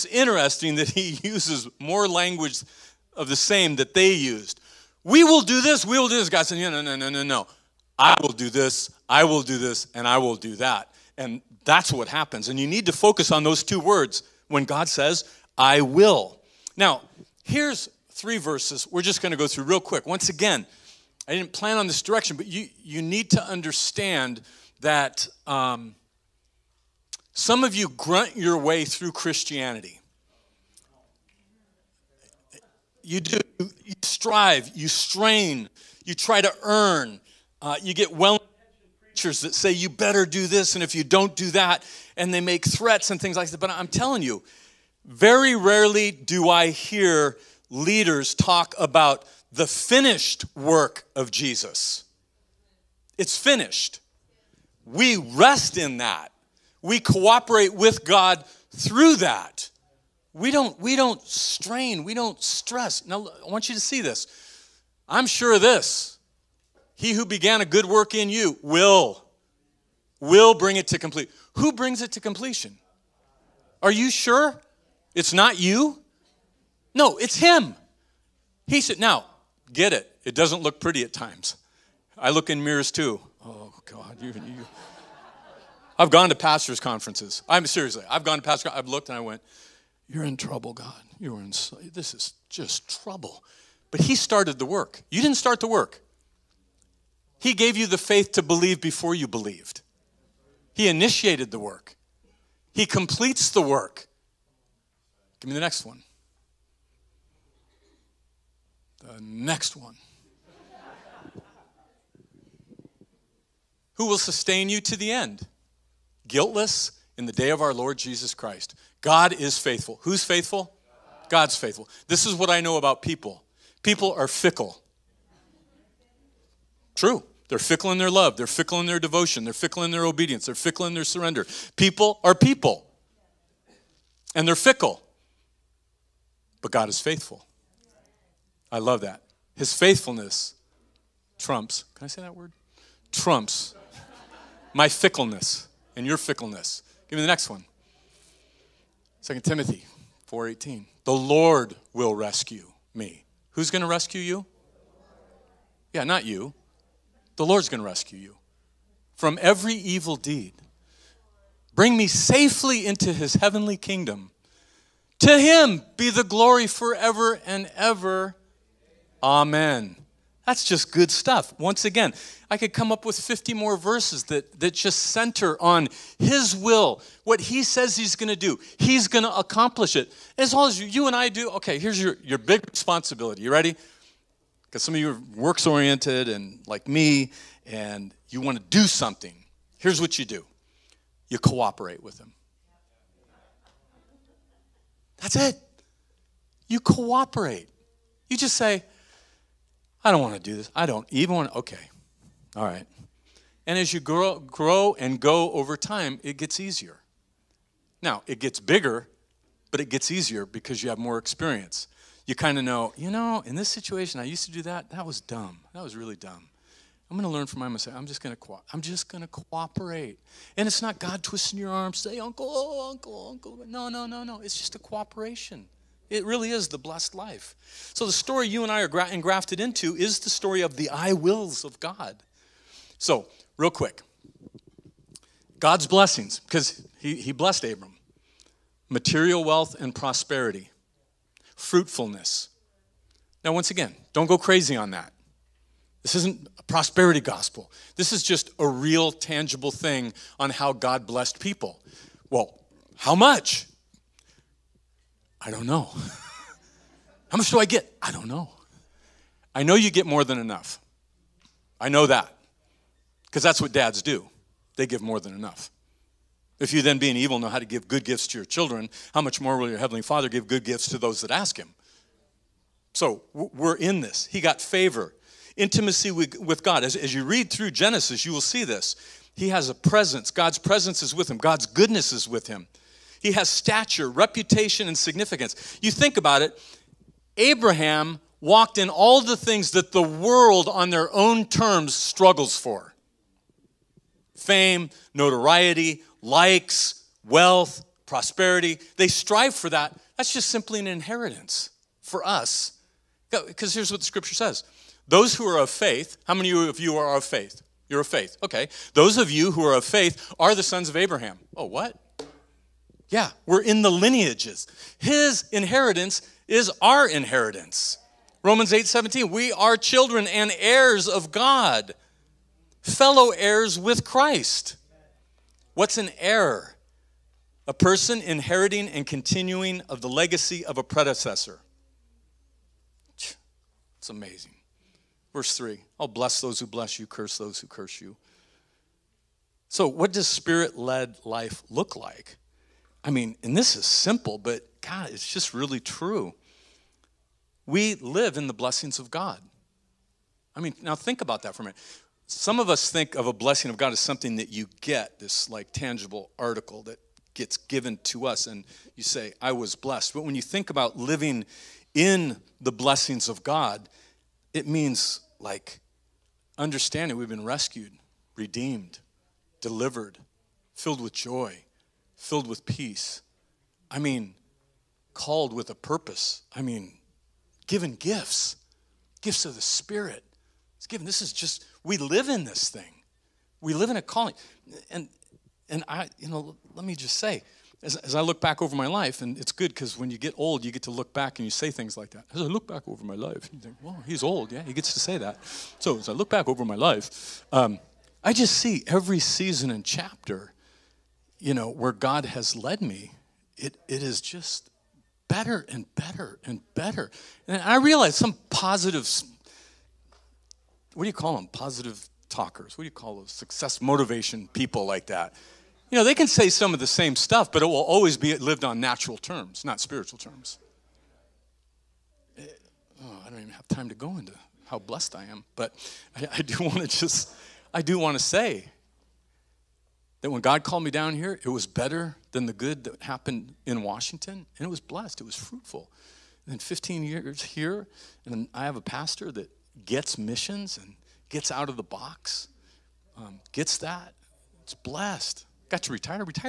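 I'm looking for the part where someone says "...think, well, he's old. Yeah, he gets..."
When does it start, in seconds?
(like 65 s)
393 s.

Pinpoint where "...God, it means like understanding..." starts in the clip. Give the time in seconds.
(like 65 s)
363 s.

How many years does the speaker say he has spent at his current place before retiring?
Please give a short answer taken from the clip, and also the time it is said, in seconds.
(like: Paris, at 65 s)
15, at 436 s.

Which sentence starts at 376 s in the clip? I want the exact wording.
I mean, given gifts, gifts of the Spirit.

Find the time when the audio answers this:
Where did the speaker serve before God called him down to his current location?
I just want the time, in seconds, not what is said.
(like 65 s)
433 s.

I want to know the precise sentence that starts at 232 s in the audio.
So, real quick God's blessings, because he, he blessed Abram material wealth and prosperity, fruitfulness.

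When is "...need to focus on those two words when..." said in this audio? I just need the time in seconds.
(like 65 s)
12 s.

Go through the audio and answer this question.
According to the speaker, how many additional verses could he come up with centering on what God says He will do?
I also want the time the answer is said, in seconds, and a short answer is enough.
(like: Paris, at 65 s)
50, at 173 s.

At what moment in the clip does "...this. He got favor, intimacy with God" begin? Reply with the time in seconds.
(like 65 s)
273 s.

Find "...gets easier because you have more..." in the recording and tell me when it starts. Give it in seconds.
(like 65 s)
209 s.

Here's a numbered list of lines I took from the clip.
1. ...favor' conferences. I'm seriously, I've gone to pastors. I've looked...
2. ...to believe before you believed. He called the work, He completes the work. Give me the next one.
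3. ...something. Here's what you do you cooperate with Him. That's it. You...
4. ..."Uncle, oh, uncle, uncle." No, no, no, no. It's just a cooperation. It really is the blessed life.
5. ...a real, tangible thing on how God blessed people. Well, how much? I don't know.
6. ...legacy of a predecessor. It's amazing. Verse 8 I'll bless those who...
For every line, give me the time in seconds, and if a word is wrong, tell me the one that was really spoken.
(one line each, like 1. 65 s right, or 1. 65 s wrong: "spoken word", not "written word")
1. 86 s wrong: "pastors", not "favor"
2. 98 s wrong: "initiated", not "called"
3. 188 s right
4. 222 s right
5. 248 s right
6. 330 s wrong: "3", not "8".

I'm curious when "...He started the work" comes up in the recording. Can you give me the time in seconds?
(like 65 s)
93 s.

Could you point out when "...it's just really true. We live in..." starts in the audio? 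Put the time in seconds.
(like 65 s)
345 s.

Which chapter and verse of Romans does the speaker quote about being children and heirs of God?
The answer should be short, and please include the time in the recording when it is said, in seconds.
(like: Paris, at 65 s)
Romans 8:17, at 318 s.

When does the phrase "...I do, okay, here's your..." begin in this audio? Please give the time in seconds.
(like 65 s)
181 s.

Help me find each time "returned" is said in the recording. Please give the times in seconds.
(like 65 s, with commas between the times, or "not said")
not said.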